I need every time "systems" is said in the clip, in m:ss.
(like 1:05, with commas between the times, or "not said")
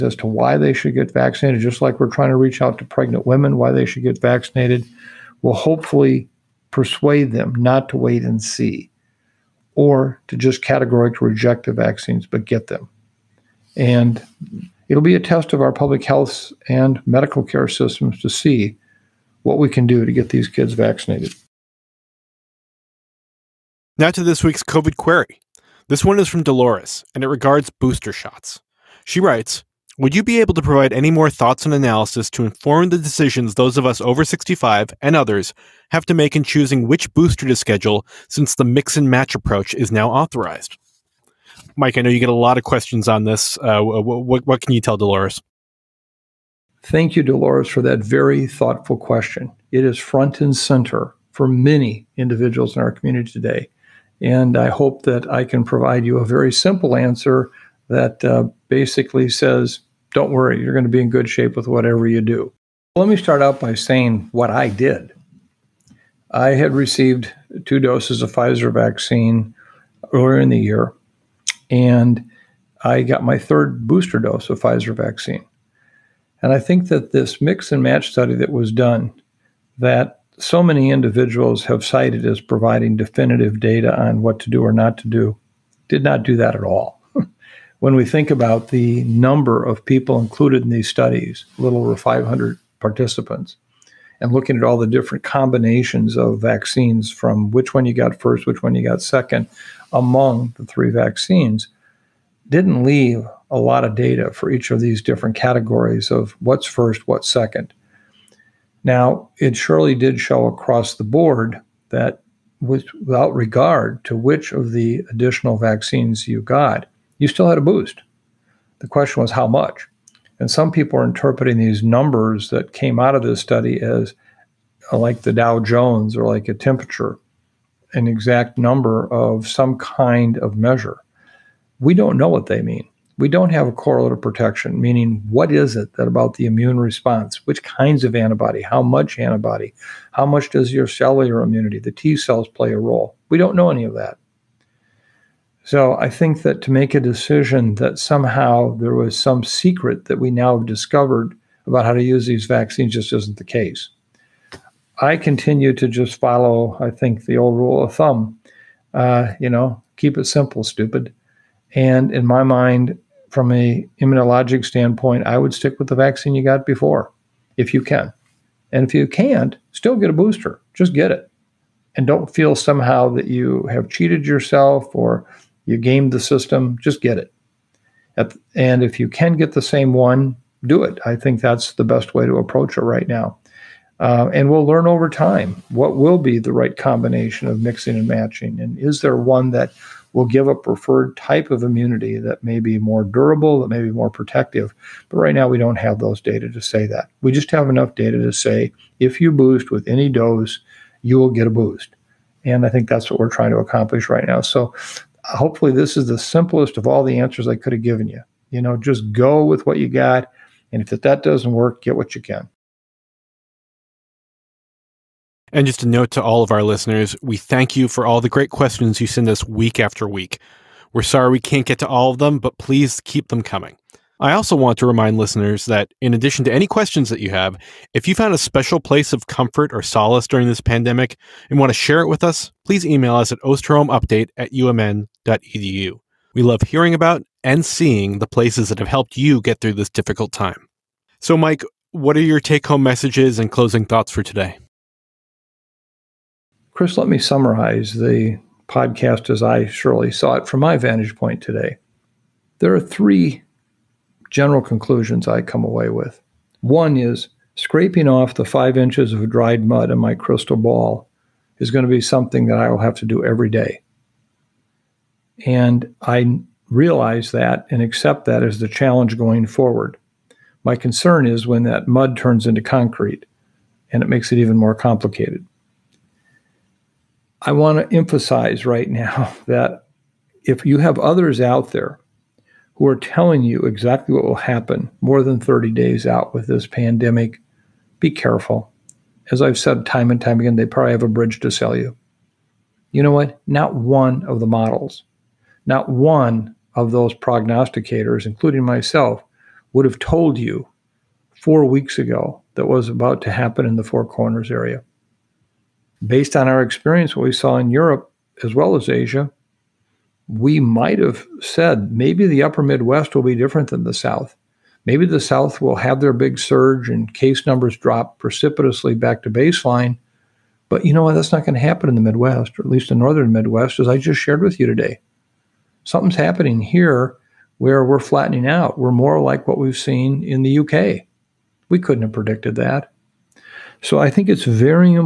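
0:17, 2:56.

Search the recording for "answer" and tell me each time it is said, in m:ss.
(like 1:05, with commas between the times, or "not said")
0:56, 3:27.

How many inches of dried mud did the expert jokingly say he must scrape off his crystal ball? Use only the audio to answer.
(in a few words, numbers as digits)
5.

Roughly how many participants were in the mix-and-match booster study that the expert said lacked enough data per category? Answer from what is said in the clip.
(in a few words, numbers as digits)
a little over 500.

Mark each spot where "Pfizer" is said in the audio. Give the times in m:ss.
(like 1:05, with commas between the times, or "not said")
1:08, 1:14.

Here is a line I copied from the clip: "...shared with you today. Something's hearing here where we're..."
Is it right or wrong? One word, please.
wrong.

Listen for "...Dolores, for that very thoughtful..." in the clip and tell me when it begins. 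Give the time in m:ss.
0:47.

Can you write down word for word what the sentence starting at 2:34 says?
I continue to just follow, I think, the old rule of thumb.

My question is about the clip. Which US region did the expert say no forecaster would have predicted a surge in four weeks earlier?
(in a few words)
Four Corners.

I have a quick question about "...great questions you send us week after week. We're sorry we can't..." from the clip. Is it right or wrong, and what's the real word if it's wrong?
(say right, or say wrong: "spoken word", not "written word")
right.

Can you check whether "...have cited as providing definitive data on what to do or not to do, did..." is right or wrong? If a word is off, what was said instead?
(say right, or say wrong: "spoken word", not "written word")
right.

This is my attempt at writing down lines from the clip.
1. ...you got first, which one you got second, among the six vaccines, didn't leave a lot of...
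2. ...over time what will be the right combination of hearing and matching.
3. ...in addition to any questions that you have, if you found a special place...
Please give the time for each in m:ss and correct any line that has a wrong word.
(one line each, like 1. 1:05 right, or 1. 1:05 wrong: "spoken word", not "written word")
1. 1:37 wrong: "three", not "six"
2. 3:04 wrong: "mixing", not "hearing"
3. 3:46 right.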